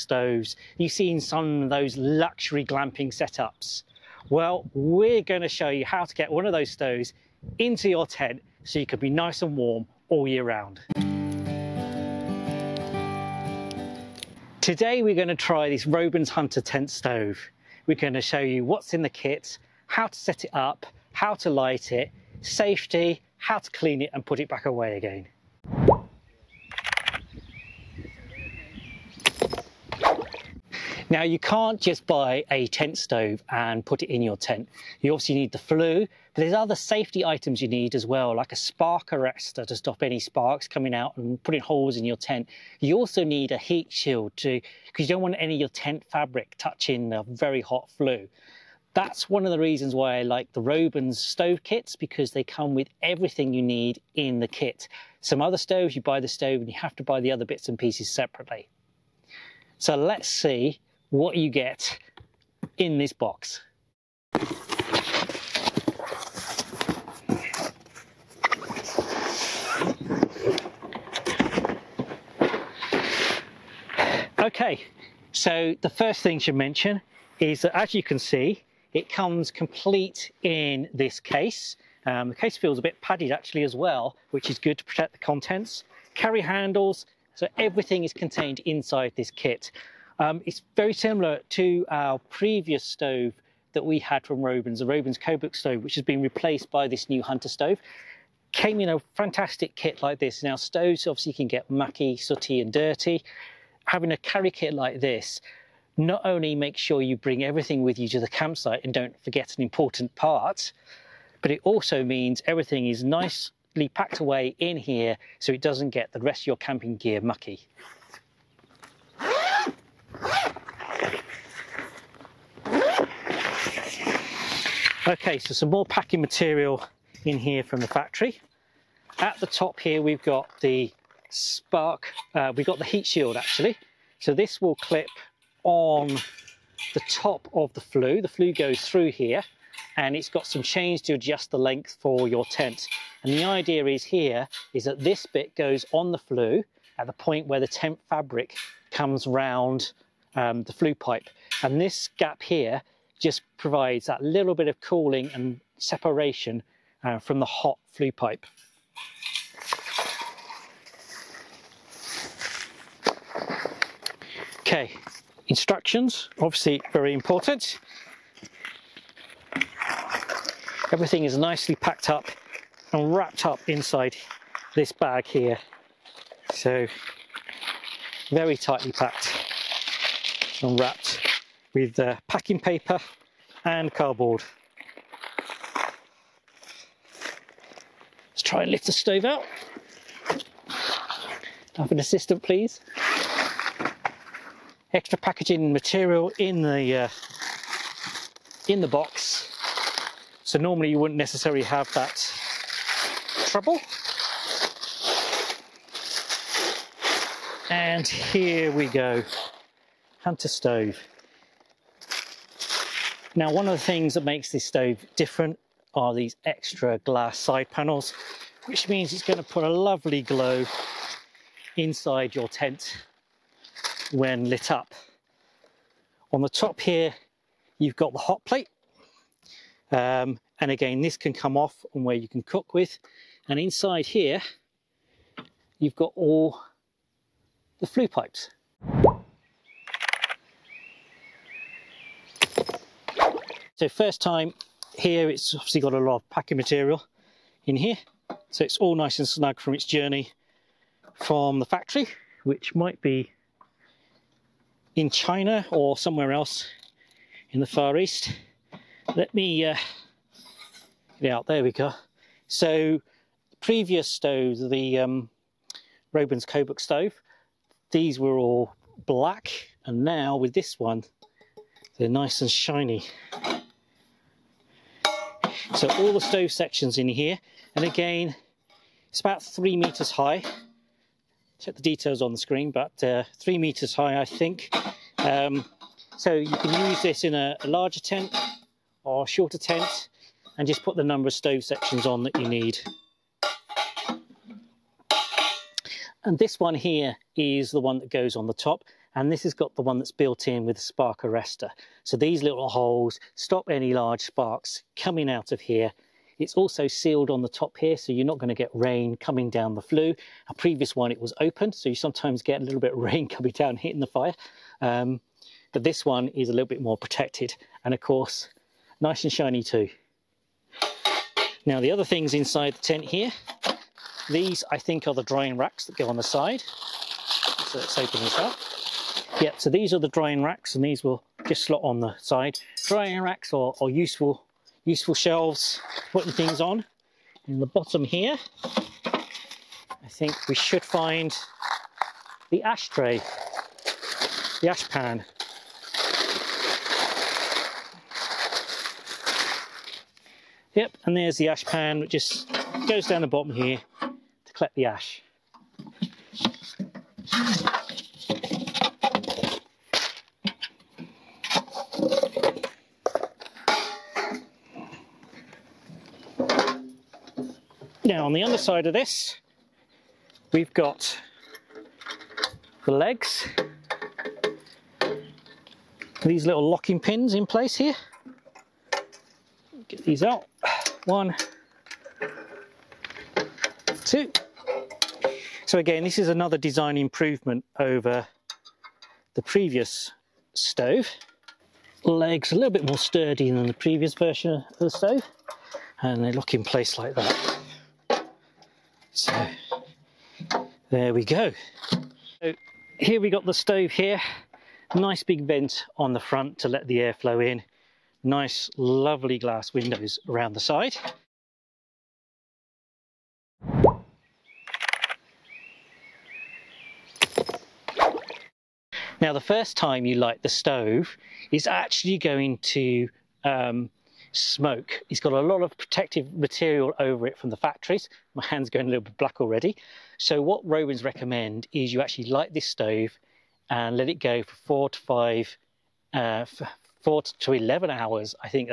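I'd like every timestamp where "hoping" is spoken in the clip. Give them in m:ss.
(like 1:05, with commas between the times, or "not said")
not said.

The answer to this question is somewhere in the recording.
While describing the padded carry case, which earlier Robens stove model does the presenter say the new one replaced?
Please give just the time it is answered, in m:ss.
1:34.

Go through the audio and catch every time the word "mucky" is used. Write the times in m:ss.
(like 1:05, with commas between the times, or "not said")
1:41, 1:57.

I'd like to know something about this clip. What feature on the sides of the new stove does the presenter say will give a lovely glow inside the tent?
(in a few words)
glass side panels.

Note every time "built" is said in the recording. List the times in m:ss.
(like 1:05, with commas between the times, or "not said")
5:00.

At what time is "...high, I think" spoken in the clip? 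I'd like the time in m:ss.
4:43.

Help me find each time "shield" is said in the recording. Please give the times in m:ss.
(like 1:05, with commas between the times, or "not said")
0:43, 2:13.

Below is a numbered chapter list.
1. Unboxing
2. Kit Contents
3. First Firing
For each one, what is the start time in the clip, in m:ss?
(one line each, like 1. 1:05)
1. 0:26
2. 3:59
3. 6:54.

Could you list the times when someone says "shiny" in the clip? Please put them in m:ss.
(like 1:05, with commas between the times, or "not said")
4:32, 5:19.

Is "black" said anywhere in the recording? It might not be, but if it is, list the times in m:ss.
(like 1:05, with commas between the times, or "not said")
4:29, 7:09.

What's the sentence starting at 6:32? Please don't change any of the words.
Legs a little bit more sturdy than the previous version of the stove and they lock in place like that.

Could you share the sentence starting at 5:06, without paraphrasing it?
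It's also sealed on the top here, so you're not going to get rain coming down the flue.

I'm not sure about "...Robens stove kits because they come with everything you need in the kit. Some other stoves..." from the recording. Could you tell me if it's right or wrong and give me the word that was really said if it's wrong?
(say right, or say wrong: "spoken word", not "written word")
right.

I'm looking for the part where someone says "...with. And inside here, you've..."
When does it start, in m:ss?
3:52.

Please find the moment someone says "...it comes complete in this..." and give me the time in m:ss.
1:18.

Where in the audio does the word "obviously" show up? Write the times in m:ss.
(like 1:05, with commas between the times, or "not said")
0:35, 1:41, 2:46, 4:05.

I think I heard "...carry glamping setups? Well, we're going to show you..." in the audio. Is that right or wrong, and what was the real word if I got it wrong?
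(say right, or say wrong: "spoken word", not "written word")
wrong: "luxury", not "carry".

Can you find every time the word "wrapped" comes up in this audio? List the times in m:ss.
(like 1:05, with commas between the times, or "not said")
2:53, 3:00.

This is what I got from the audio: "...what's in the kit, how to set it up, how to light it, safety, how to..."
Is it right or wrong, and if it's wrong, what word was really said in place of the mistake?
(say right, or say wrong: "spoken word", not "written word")
right.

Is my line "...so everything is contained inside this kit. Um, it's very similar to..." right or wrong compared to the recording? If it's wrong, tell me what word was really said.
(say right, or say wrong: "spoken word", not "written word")
right.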